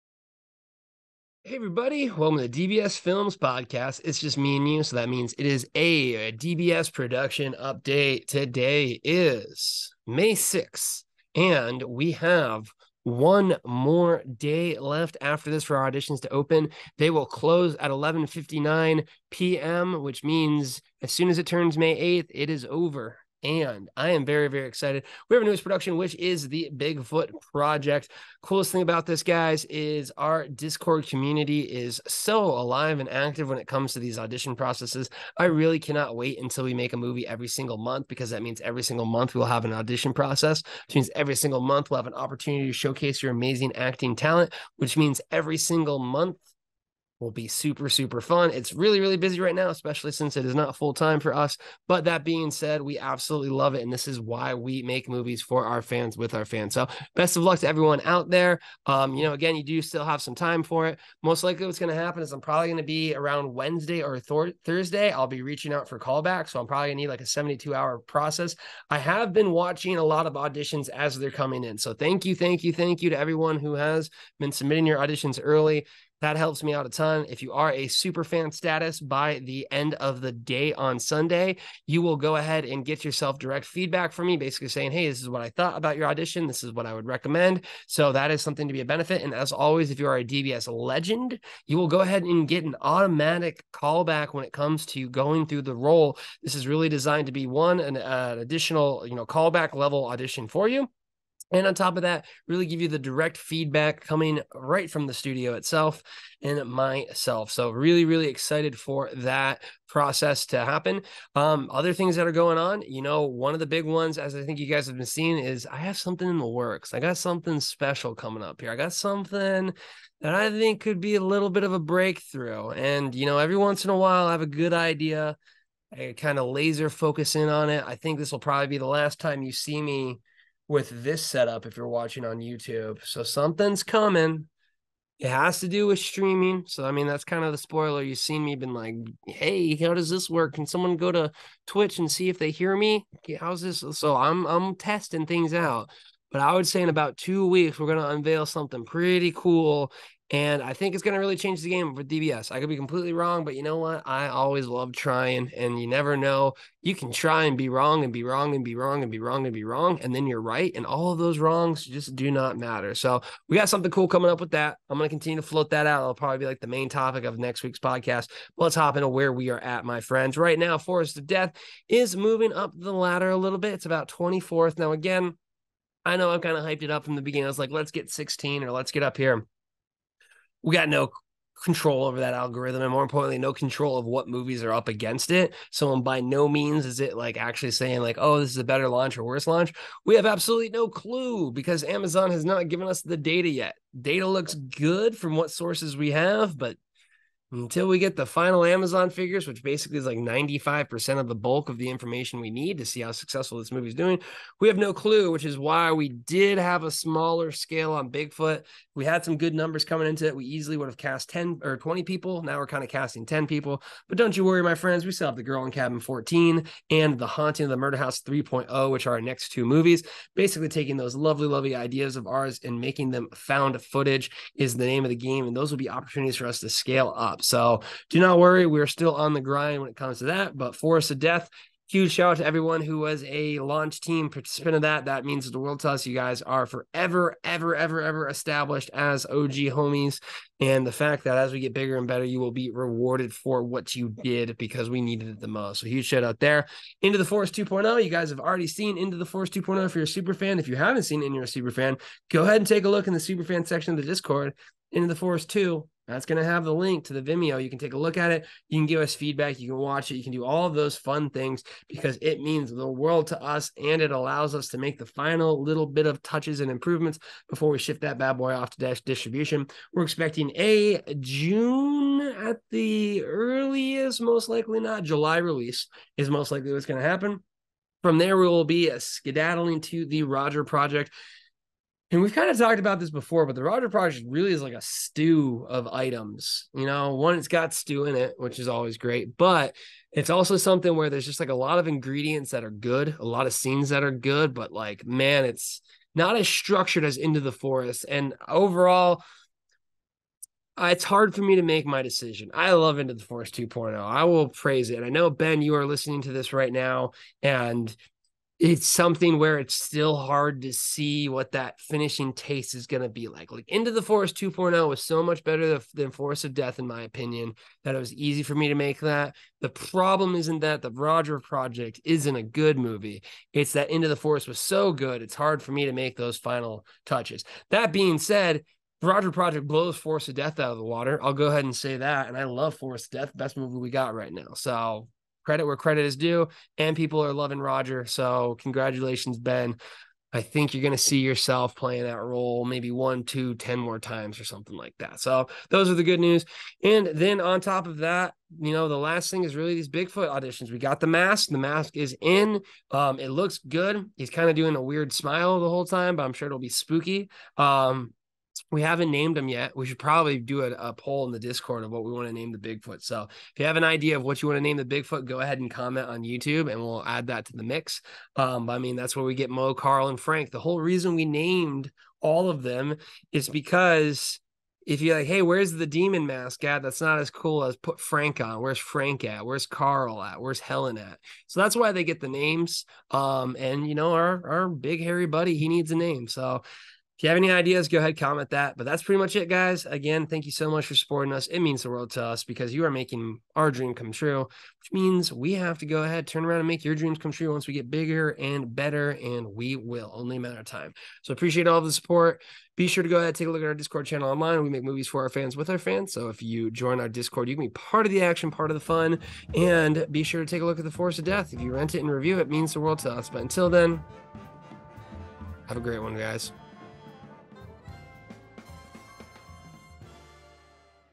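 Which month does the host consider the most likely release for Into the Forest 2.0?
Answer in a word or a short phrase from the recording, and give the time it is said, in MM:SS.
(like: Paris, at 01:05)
July, at 04:35.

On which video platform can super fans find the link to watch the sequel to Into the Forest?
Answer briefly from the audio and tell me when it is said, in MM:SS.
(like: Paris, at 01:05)
Vimeo, at 04:17.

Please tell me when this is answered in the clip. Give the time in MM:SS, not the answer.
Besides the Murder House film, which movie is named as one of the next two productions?
03:35.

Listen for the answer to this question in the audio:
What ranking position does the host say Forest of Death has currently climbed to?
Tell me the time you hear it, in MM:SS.
02:54.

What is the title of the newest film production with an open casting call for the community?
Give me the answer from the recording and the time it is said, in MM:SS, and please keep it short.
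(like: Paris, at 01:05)
Bigfoot Project, at 00:26.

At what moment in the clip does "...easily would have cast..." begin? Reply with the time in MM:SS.
03:30.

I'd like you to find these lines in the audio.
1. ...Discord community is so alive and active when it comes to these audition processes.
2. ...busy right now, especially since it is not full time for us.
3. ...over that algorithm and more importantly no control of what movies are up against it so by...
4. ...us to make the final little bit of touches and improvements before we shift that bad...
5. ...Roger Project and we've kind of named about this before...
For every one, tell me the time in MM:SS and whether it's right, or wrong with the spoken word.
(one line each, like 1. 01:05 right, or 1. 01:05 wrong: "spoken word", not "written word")
1. 00:30 right
2. 00:49 right
3. 03:02 right
4. 04:24 right
5. 04:40 wrong: "talked", not "named".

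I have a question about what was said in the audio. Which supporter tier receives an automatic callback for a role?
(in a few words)
DBS legend.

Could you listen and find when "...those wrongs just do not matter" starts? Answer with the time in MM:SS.
02:41.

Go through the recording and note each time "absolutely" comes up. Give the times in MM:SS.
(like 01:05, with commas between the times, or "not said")
00:52, 03:10.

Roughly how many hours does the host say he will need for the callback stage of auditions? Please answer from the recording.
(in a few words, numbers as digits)
72.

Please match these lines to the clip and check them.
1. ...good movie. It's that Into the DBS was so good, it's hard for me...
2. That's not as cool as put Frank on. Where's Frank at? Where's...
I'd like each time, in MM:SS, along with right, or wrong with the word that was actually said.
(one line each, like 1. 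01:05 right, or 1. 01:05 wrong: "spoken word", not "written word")
1. 05:22 wrong: "Forest", not "DBS"
2. 06:16 right.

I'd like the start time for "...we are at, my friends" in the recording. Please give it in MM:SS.
02:49.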